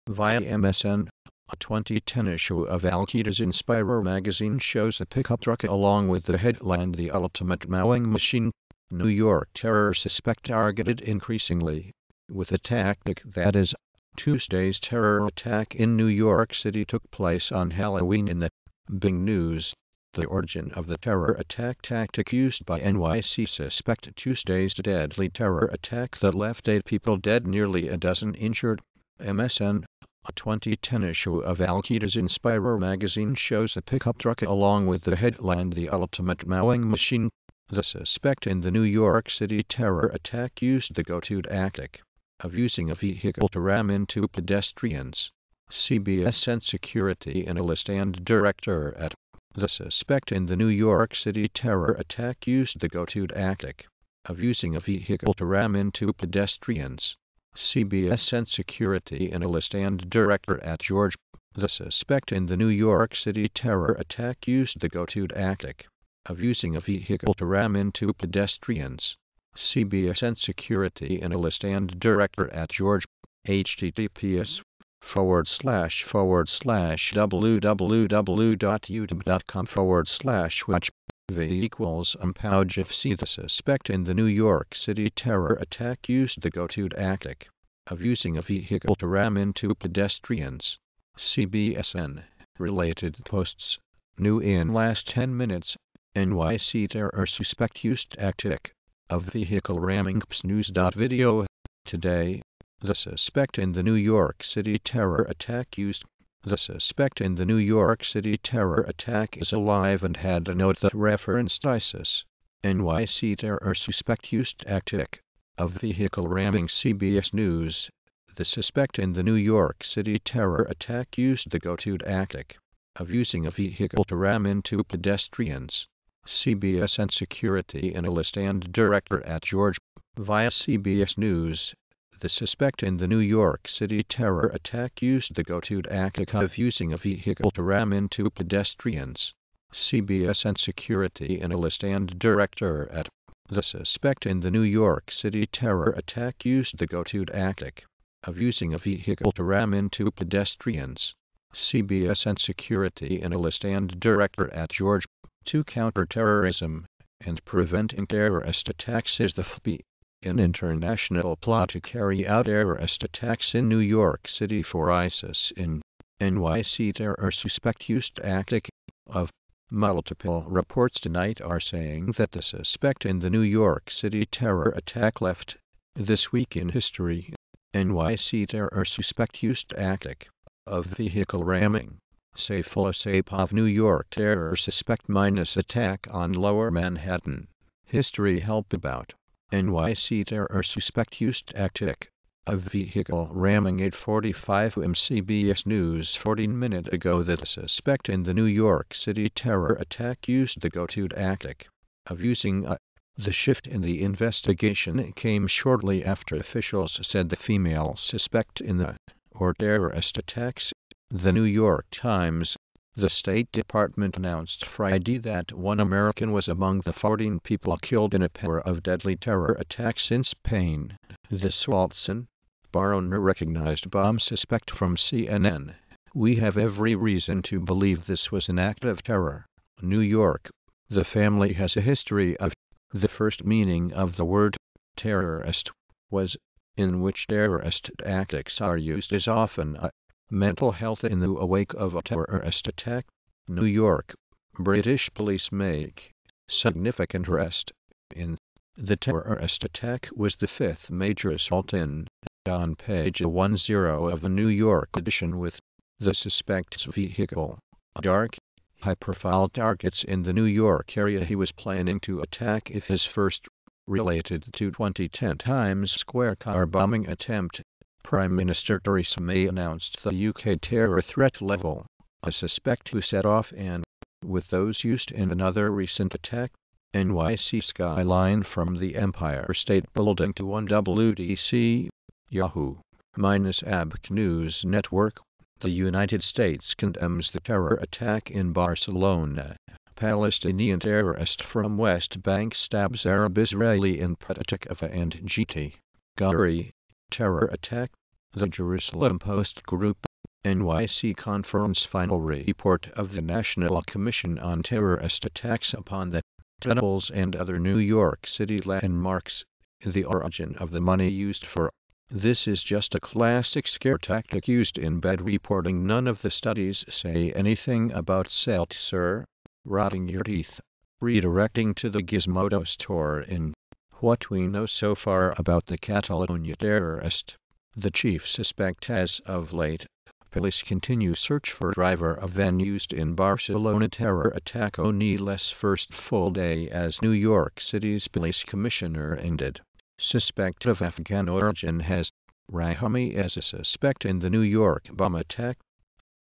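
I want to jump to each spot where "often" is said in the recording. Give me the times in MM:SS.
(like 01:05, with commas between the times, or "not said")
03:59.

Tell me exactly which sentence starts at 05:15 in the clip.
None of the studies say anything about salt, sir.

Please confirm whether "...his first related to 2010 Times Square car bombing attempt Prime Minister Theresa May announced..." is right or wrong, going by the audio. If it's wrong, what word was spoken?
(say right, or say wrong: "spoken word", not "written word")
right.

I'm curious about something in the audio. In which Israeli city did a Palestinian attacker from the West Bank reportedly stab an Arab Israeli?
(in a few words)
Petah Tikva.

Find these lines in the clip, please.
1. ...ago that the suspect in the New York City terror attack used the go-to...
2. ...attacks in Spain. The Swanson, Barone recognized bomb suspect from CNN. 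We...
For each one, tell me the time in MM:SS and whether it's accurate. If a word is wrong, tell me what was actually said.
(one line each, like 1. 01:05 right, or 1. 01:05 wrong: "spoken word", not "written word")
1. 03:16 right
2. 03:39 right.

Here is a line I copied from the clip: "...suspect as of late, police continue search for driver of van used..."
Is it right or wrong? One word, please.
right.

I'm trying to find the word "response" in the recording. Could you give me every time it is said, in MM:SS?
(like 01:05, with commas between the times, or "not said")
not said.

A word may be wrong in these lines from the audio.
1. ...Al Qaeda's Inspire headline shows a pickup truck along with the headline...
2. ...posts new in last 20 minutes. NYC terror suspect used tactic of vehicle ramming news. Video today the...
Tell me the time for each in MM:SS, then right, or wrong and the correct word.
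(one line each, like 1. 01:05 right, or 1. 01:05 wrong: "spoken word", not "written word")
1. 00:02 wrong: "magazine", not "headline"
2. 01:33 wrong: "10", not "20".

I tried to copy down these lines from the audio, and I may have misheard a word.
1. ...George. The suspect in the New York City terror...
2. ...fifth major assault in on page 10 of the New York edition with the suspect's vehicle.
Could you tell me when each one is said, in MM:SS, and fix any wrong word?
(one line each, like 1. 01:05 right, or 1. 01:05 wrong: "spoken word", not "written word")
1. 01:00 right
2. 04:10 right.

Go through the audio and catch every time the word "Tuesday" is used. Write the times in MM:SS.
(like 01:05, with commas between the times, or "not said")
00:14, 00:24.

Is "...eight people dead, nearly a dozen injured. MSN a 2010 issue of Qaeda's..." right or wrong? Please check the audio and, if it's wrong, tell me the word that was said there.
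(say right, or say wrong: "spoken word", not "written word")
right.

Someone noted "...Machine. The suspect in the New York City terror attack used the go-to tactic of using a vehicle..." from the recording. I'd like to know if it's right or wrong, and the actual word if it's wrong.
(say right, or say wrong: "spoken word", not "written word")
right.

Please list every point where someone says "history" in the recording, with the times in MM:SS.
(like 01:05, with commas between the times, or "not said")
02:56, 03:07, 03:51.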